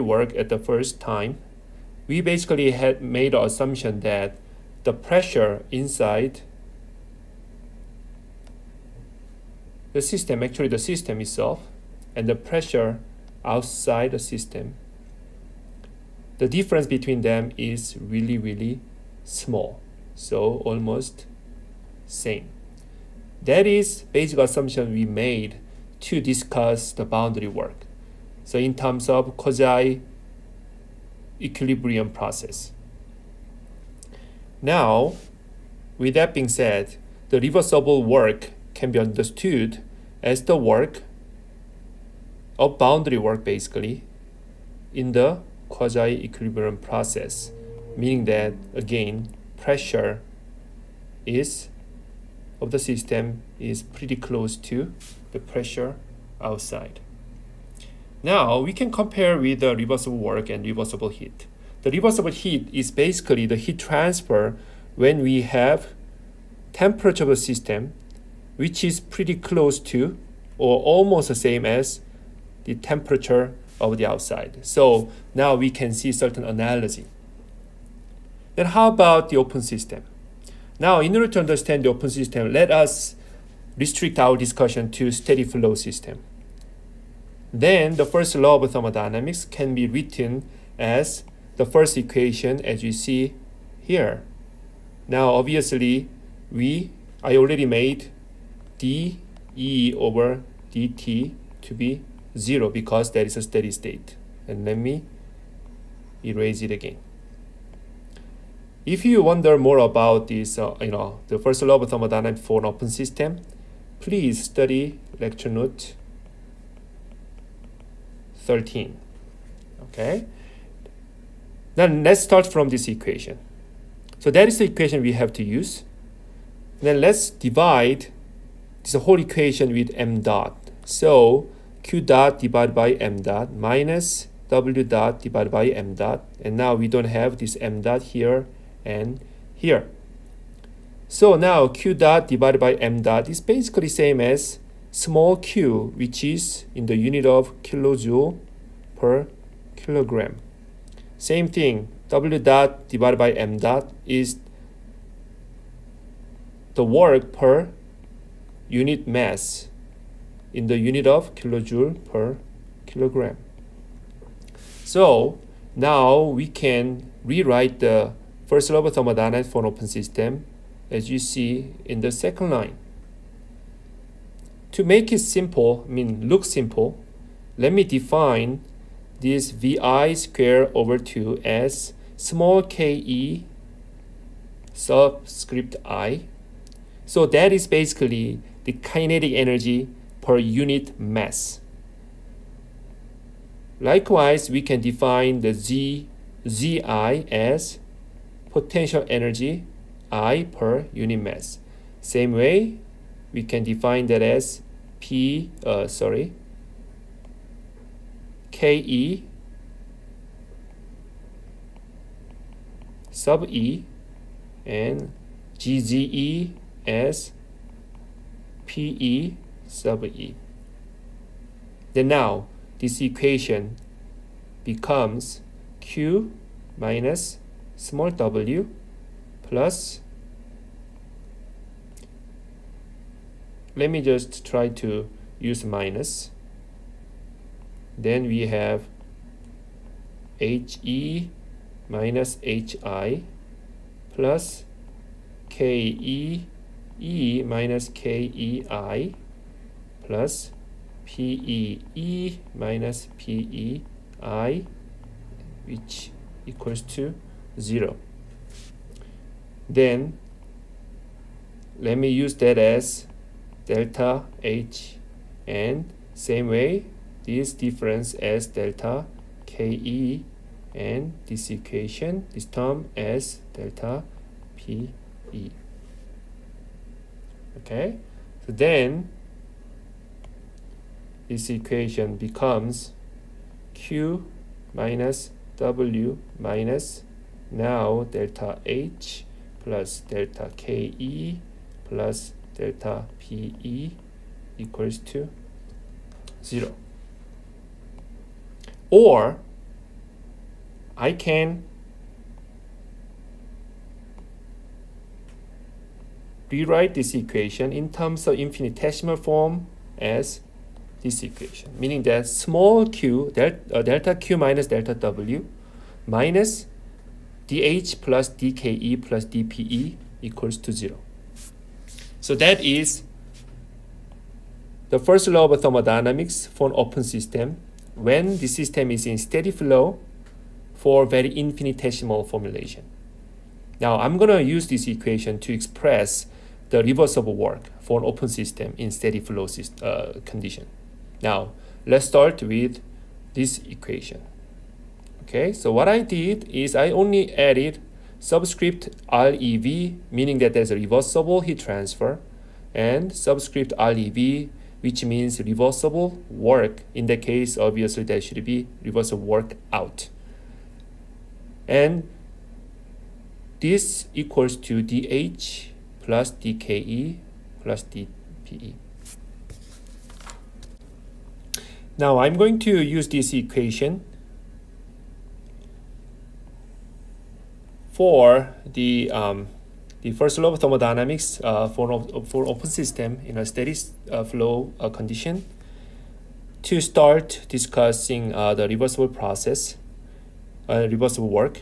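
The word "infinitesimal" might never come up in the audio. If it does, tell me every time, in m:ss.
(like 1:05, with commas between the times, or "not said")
5:08, 5:31.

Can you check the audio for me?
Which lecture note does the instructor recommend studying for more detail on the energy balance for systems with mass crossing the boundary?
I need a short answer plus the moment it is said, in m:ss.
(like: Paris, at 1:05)
Lecture note 13, at 1:55.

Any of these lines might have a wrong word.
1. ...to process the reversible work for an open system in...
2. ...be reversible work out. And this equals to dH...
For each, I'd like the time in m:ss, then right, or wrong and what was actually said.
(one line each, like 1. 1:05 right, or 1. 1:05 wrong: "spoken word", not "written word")
1. 5:35 wrong: "express", not "process"
2. 5:58 right.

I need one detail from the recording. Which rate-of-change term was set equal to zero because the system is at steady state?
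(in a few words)
dE over dt.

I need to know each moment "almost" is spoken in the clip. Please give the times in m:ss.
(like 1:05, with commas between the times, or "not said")
0:20, 1:10.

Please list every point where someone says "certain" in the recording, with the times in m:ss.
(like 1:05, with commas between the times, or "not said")
1:16.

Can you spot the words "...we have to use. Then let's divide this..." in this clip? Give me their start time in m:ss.
2:05.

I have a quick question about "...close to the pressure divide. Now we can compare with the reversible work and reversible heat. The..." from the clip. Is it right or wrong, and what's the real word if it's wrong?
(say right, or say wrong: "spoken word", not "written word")
wrong: "outside", not "divide".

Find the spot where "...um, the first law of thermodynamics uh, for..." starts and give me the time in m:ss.
6:19.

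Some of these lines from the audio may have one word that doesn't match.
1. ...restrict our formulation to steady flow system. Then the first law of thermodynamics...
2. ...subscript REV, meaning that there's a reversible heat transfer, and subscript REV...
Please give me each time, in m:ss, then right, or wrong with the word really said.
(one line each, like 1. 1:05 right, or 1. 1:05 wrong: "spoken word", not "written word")
1. 1:23 wrong: "discussion", not "formulation"
2. 5:48 right.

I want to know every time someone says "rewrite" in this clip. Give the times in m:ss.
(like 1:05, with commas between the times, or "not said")
2:47, 5:06.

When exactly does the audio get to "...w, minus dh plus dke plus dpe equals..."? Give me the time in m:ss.
5:14.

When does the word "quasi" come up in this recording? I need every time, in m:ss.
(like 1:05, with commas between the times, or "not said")
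0:29, 0:45.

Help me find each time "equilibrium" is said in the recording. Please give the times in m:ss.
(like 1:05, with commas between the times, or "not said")
0:31, 0:45.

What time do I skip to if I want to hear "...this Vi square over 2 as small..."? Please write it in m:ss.
2:59.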